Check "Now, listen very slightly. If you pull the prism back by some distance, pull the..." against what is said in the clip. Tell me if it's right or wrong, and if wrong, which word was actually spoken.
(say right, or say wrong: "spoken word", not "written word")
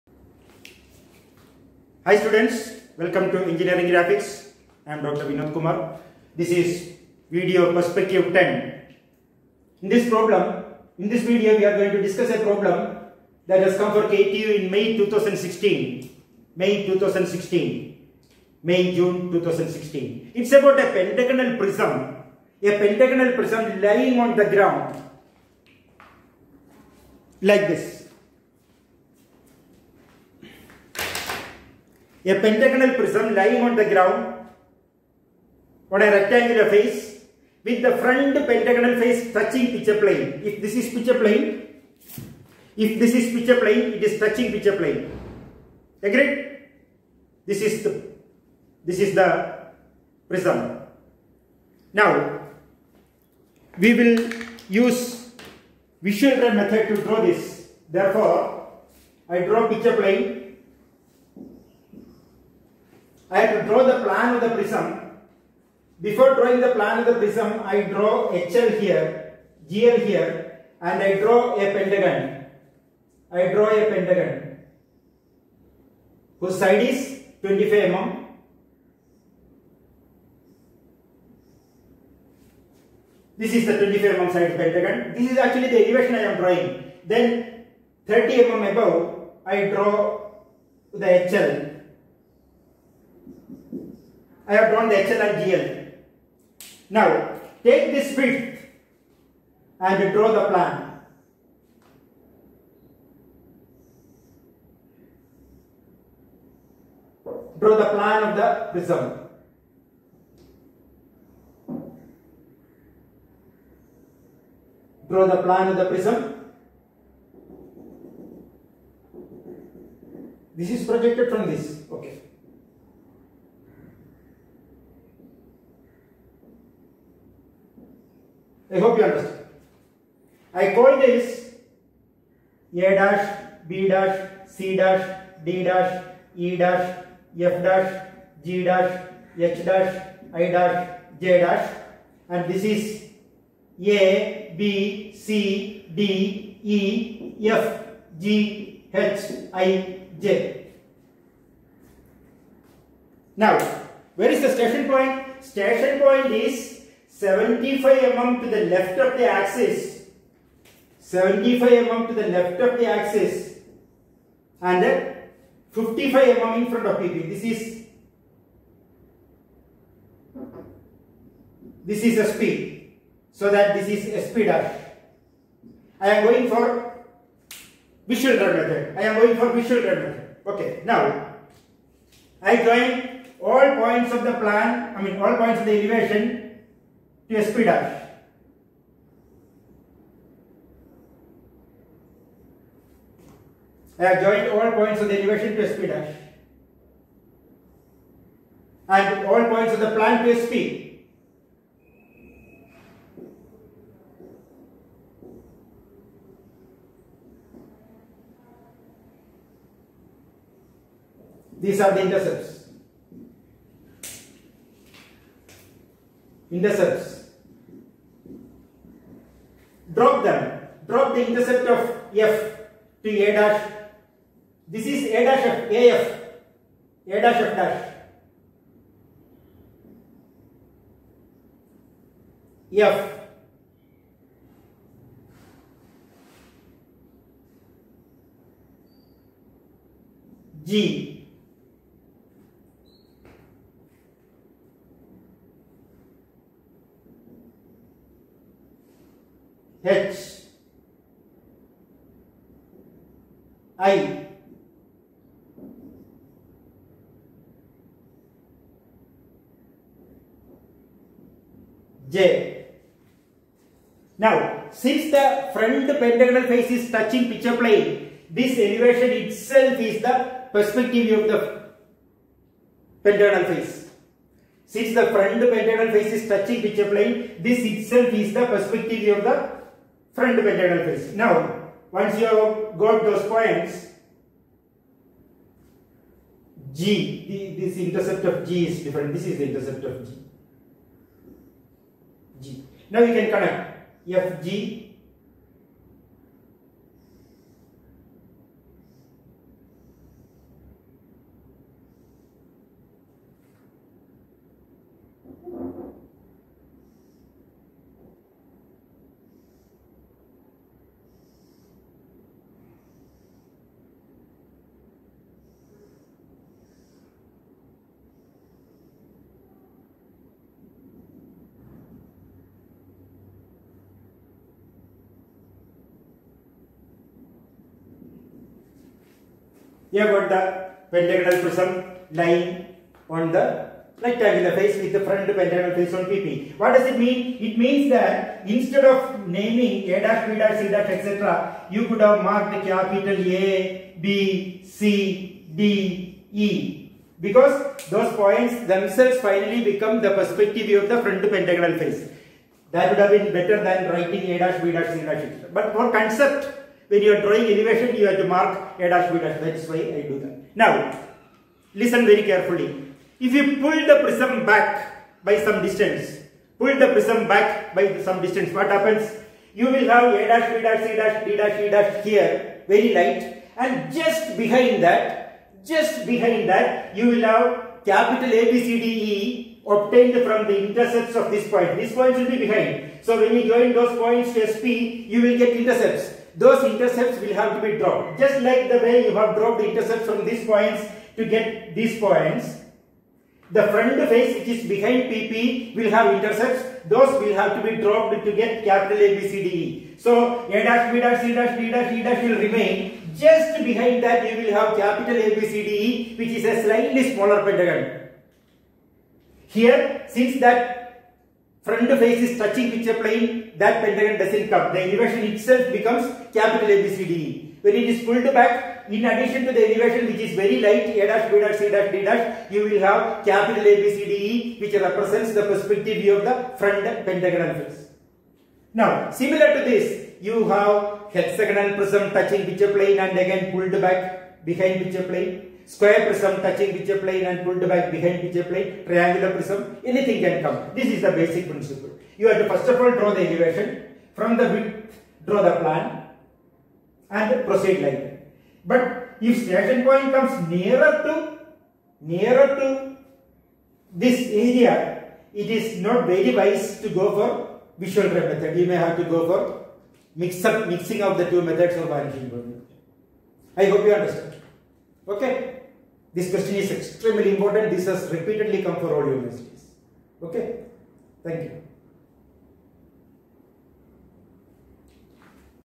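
wrong: "carefully", not "slightly".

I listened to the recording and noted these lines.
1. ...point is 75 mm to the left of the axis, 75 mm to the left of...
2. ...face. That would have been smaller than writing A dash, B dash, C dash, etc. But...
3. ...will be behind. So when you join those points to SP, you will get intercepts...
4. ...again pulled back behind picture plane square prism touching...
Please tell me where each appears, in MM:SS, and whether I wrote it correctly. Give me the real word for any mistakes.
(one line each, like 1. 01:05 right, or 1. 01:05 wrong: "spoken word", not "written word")
1. 02:35 right
2. 05:51 wrong: "better", not "smaller"
3. 06:22 right
4. 07:13 right.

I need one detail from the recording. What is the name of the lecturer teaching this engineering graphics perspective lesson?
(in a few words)
Dr. Vinod Kumar.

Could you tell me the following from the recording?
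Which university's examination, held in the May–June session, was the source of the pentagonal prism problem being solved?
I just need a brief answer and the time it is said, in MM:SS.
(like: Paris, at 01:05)
KTU, at 00:14.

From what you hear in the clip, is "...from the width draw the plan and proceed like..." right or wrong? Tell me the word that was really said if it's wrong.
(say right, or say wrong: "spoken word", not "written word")
right.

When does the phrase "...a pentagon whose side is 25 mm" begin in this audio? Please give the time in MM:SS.
01:13.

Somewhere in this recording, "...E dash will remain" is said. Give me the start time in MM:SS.
06:41.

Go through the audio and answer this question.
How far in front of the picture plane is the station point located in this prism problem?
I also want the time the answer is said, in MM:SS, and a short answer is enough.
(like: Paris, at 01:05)
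55 mm, at 02:45.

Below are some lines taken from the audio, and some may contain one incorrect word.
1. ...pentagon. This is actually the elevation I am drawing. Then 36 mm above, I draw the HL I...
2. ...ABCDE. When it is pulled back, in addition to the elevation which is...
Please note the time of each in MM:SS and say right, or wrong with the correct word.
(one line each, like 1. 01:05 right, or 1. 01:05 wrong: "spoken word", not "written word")
1. 01:24 wrong: "30", not "36"
2. 06:56 right.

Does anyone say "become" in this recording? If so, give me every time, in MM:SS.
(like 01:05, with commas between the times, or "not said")
05:49, 06:55.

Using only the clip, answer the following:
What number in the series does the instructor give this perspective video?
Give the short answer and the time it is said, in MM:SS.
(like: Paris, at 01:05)
10, at 00:08.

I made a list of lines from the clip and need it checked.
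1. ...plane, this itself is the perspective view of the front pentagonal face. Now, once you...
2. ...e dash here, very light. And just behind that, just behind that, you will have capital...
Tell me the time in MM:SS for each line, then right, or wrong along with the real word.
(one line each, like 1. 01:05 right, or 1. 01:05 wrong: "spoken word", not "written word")
1. 04:36 right
2. 06:11 right.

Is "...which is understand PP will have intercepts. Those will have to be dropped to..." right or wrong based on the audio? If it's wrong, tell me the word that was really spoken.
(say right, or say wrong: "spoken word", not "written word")
wrong: "behind", not "understand".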